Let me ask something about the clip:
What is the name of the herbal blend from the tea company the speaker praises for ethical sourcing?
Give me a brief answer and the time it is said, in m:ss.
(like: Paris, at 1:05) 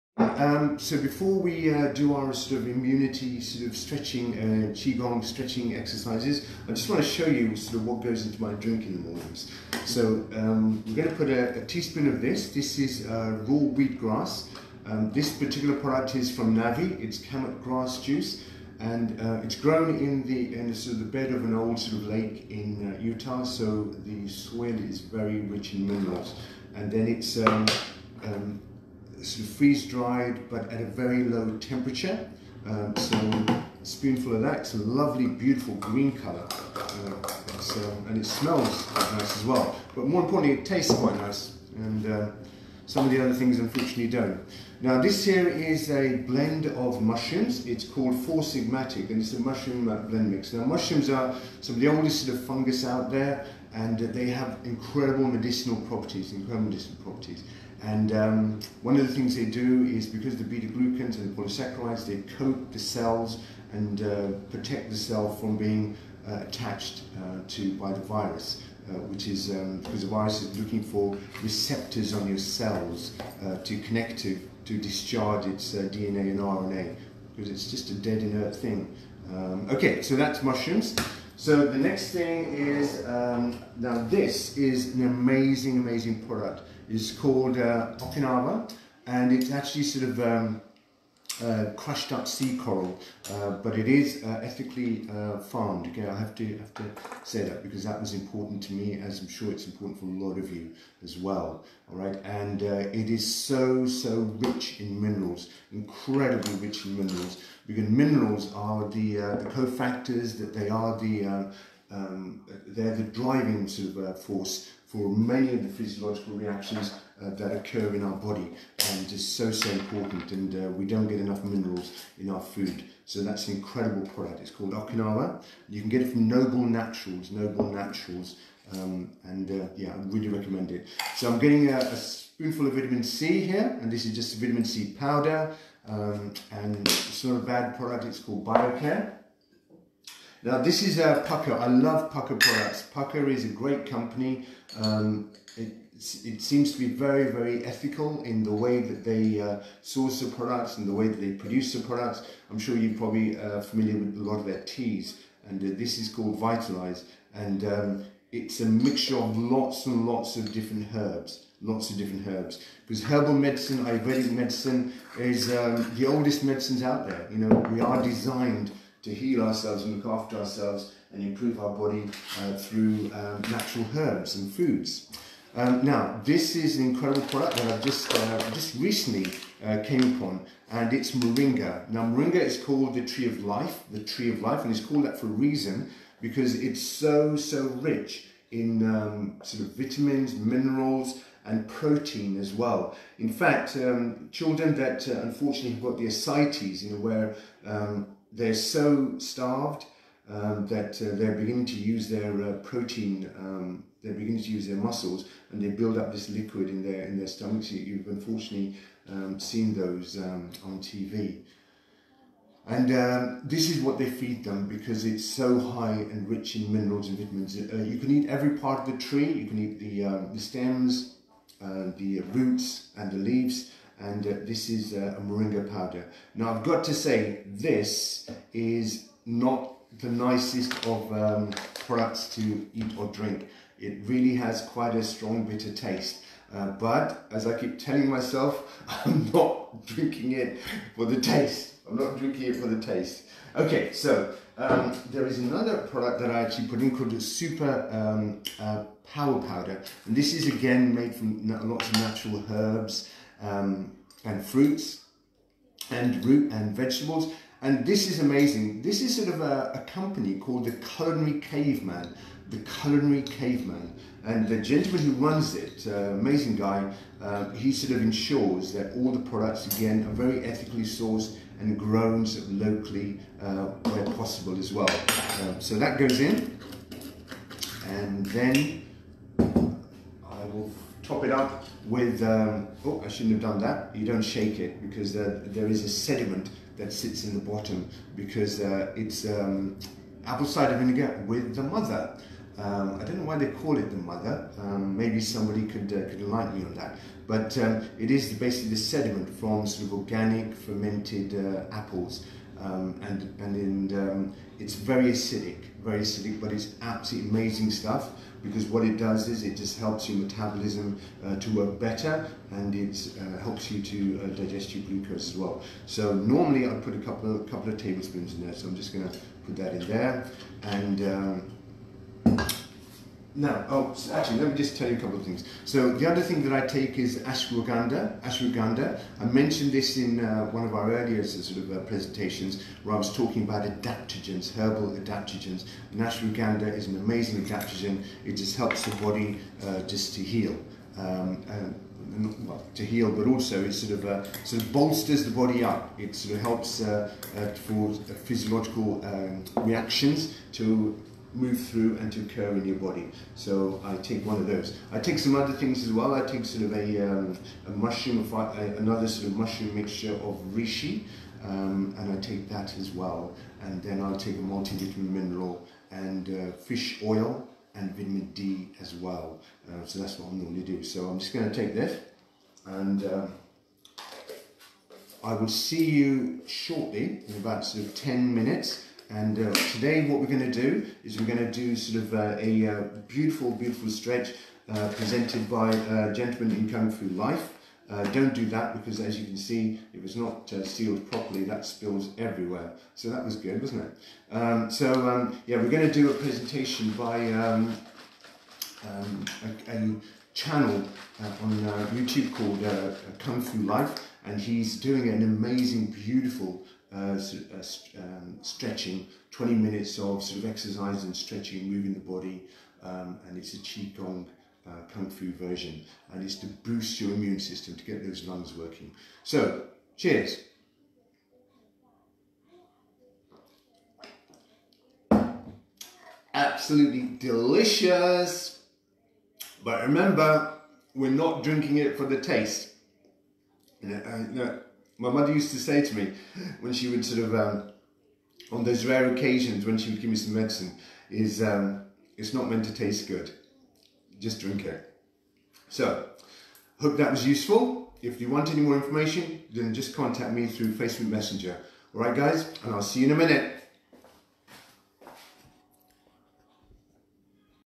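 Vitalize, at 2:36.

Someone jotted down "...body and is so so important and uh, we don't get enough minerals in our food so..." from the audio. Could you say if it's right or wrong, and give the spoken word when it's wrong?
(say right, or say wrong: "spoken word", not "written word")
right.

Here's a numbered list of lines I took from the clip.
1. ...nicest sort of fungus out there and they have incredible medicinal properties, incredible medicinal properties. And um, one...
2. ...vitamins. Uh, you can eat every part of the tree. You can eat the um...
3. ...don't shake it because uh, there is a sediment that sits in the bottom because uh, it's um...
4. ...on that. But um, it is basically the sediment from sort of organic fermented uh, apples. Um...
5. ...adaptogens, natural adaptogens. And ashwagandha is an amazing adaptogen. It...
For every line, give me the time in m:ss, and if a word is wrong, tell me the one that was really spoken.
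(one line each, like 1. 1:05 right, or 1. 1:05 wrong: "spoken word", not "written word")
1. 0:51 wrong: "oldest", not "nicest"
2. 3:37 right
3. 4:44 right
4. 4:56 right
5. 5:33 wrong: "herbal", not "natural".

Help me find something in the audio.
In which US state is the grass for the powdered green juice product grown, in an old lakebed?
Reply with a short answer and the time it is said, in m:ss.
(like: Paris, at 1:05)
Utah, at 0:22.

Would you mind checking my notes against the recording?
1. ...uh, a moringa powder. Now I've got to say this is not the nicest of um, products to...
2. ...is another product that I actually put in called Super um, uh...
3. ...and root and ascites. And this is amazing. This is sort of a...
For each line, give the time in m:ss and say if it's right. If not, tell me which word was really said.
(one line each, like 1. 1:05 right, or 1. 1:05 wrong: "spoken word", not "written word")
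1. 3:44 right
2. 4:05 right
3. 4:15 wrong: "vegetables", not "ascites".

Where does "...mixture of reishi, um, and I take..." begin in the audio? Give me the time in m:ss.
5:59.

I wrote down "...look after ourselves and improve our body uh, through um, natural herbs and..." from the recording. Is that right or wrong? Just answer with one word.
right.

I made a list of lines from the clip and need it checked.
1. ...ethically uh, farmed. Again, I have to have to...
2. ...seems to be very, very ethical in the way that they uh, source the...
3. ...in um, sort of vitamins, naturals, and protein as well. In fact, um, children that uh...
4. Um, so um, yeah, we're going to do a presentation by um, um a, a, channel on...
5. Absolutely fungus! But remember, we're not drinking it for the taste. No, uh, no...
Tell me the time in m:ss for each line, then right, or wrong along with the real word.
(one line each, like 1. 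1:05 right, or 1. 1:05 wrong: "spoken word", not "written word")
1. 1:34 right
2. 2:26 right
3. 3:08 wrong: "minerals", not "naturals"
4. 6:34 right
5. 7:06 wrong: "delicious", not "fungus".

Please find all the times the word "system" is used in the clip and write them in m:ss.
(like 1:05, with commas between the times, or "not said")
6:57.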